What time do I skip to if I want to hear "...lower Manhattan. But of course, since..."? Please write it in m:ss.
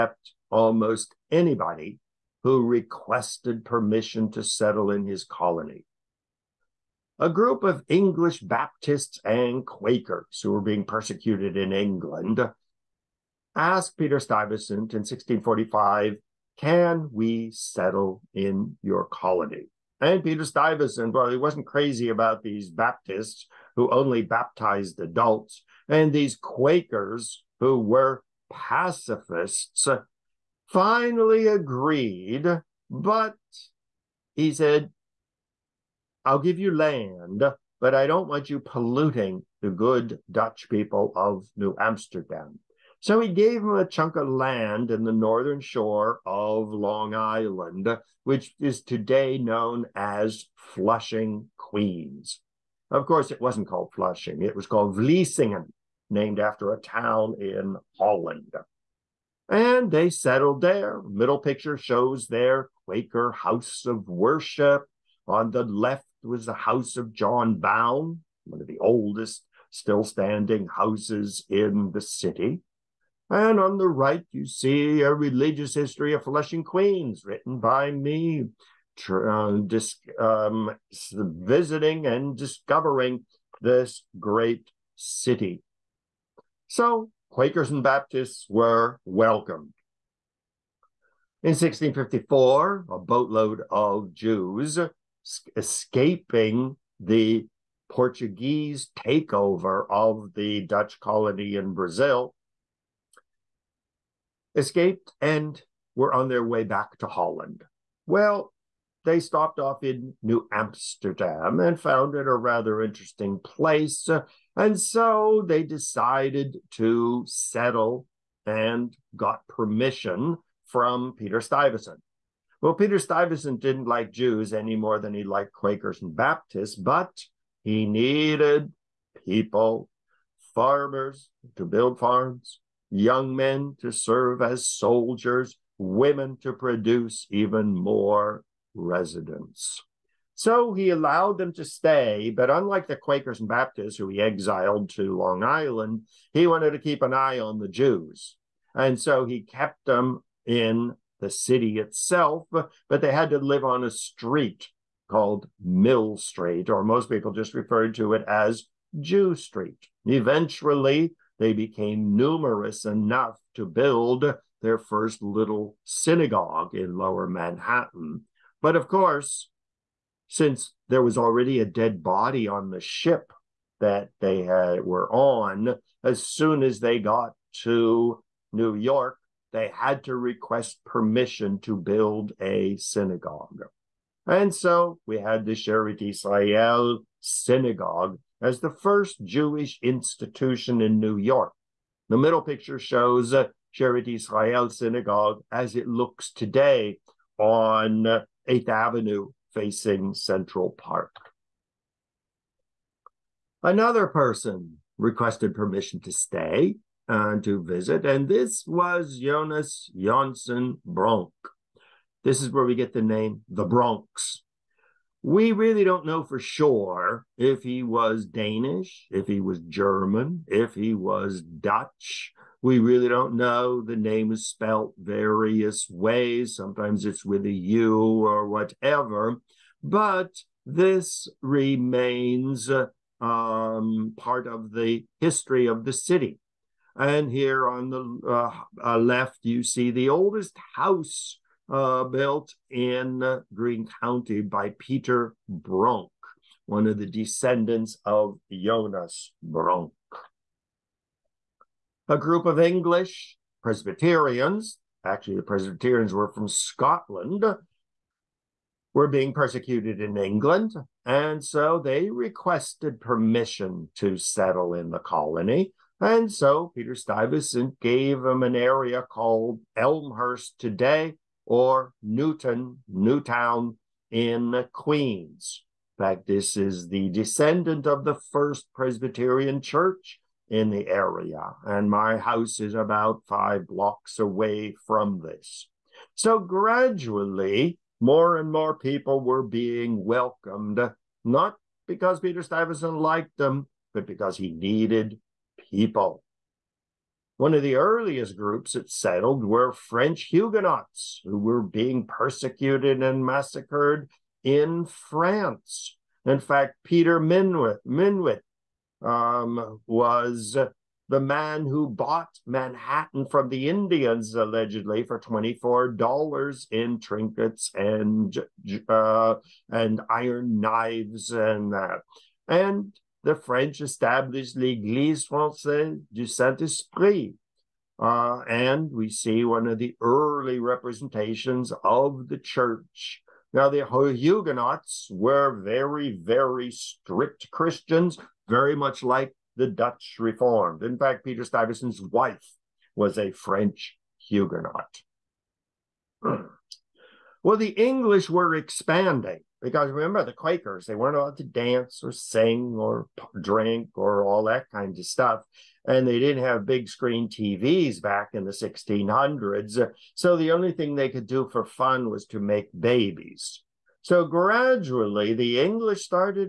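2:46.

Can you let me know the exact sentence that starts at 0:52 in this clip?
Of course, it wasn't called Flushing, it was called Vlissingen, named after a town in Holland.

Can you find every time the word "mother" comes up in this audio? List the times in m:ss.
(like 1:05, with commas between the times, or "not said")
not said.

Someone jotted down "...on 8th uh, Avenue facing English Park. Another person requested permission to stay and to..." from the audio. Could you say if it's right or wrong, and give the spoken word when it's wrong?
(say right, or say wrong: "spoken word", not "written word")
wrong: "Central", not "English".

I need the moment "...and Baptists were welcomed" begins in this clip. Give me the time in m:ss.
1:27.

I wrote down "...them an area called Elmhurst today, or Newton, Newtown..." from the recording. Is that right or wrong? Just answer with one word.
right.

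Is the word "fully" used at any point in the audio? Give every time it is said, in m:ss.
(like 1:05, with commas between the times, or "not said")
not said.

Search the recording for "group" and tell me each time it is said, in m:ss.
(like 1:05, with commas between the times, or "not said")
0:07, 4:12, 4:58.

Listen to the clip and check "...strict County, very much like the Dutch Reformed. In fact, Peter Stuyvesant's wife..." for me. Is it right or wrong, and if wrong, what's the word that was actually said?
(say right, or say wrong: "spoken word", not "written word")
wrong: "Christians", not "County".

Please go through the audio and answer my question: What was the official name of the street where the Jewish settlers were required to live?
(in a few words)
Mill Street.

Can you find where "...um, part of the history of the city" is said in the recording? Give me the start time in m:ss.
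3:53.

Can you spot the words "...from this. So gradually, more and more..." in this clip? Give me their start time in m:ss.
4:44.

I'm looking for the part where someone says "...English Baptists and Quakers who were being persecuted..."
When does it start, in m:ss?
0:07.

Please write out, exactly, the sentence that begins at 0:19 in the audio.
And Peter Stuyvesant, well, he wasn't crazy about these Baptists who only baptized adults and these Quakers who were pacifists, finally agreed.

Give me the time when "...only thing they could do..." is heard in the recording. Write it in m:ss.
6:00.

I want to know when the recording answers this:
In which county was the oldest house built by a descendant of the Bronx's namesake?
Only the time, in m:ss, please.
4:03.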